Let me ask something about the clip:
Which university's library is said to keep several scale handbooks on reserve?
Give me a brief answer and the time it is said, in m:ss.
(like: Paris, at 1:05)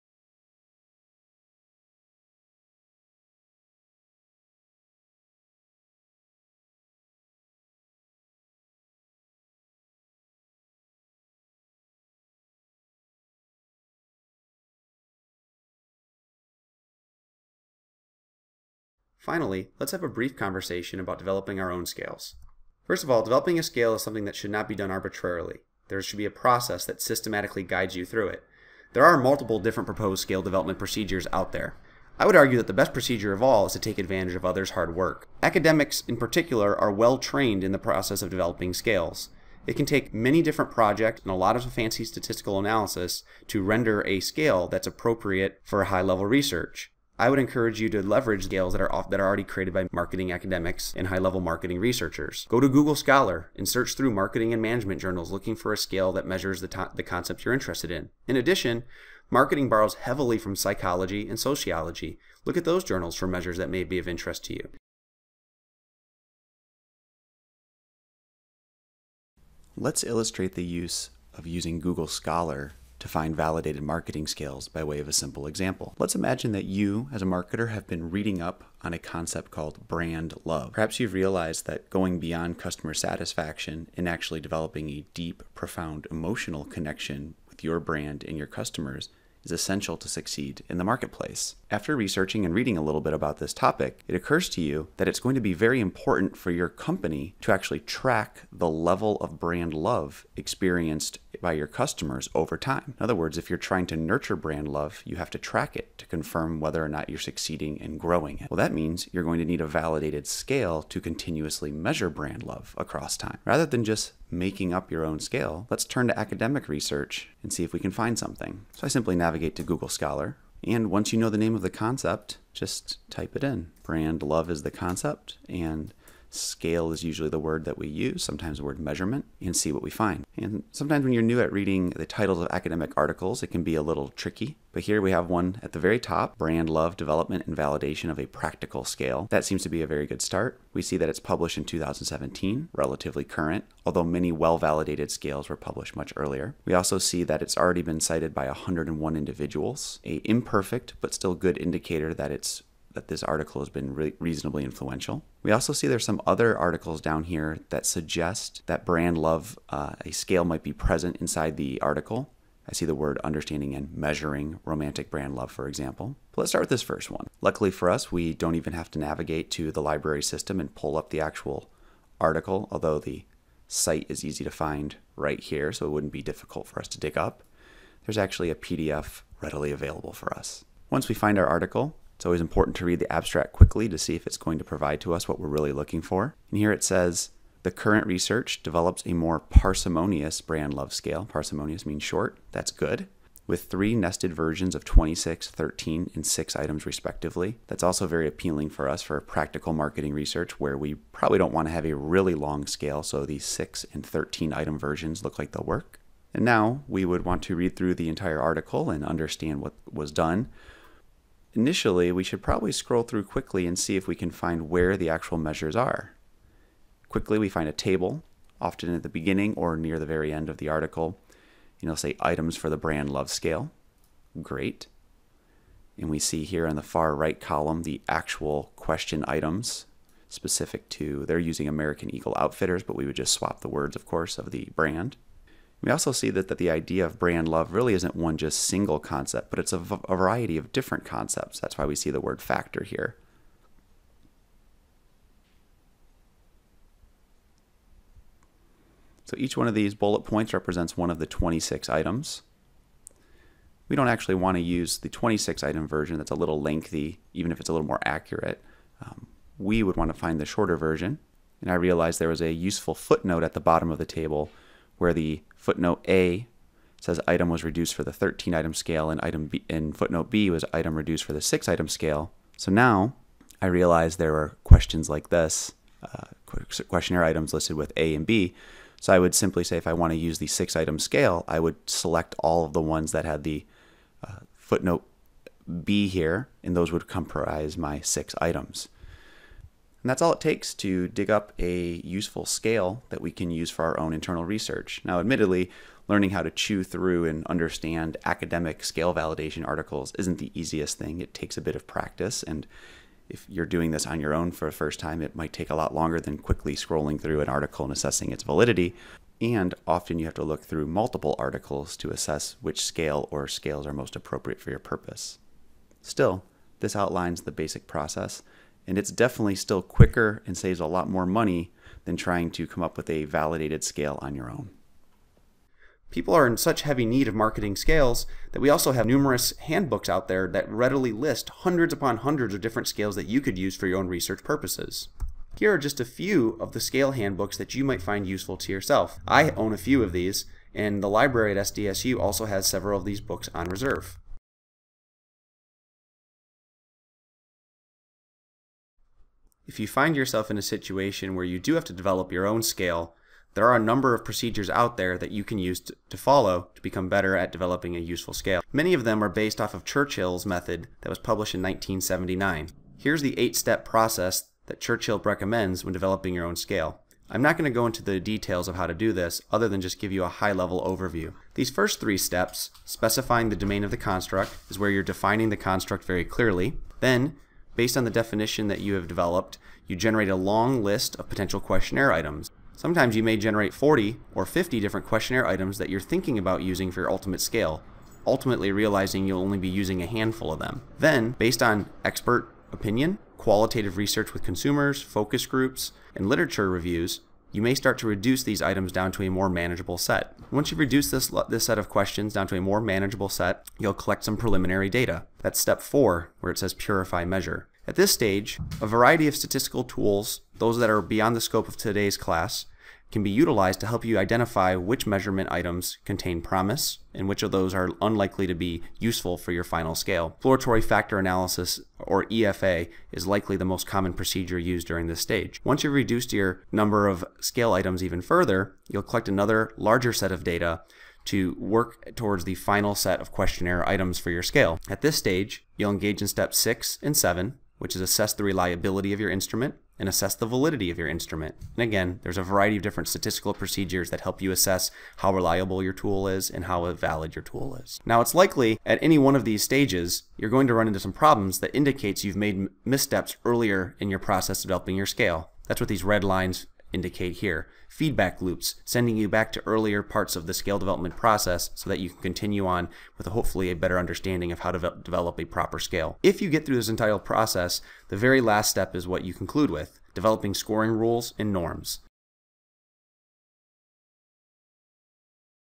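SDSU, at 5:41.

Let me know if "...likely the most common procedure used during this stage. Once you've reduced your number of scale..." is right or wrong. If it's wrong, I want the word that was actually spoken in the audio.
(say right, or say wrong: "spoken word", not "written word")
right.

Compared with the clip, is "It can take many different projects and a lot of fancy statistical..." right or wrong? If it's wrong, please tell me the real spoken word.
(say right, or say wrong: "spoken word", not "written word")
right.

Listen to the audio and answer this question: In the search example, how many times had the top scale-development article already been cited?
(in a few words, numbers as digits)
101.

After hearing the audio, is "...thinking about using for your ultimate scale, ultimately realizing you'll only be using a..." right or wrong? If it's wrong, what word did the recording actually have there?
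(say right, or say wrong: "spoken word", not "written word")
right.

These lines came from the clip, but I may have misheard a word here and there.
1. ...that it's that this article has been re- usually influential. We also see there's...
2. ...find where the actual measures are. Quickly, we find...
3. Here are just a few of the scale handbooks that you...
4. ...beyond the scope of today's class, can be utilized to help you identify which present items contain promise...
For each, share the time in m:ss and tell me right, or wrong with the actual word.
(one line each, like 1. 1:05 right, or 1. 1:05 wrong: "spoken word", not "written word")
1. 2:32 wrong: "reasonably", not "usually"
2. 3:34 right
3. 5:35 right
4. 6:51 wrong: "measurement", not "present".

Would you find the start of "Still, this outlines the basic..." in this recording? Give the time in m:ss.
5:16.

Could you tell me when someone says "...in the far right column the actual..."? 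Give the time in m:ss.
3:46.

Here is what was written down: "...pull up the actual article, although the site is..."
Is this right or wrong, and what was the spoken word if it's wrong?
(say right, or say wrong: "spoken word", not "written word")
right.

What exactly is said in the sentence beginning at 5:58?
Many of them are based off of Churchill's method that was published in 1979.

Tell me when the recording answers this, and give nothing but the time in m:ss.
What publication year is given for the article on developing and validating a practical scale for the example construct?
2:21.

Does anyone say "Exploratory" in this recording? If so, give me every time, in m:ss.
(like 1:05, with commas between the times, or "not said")
7:00.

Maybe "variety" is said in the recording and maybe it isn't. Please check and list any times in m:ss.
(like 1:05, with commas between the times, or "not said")
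3:59, 6:48, 7:22.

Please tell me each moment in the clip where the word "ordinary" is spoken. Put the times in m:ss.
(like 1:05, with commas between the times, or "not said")
not said.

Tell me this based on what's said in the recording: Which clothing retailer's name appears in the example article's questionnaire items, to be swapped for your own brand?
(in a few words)
American Eagle Outfitters.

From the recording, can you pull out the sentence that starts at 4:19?
Um, we would want to find the shorter version.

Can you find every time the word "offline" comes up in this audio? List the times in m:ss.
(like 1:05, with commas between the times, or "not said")
not said.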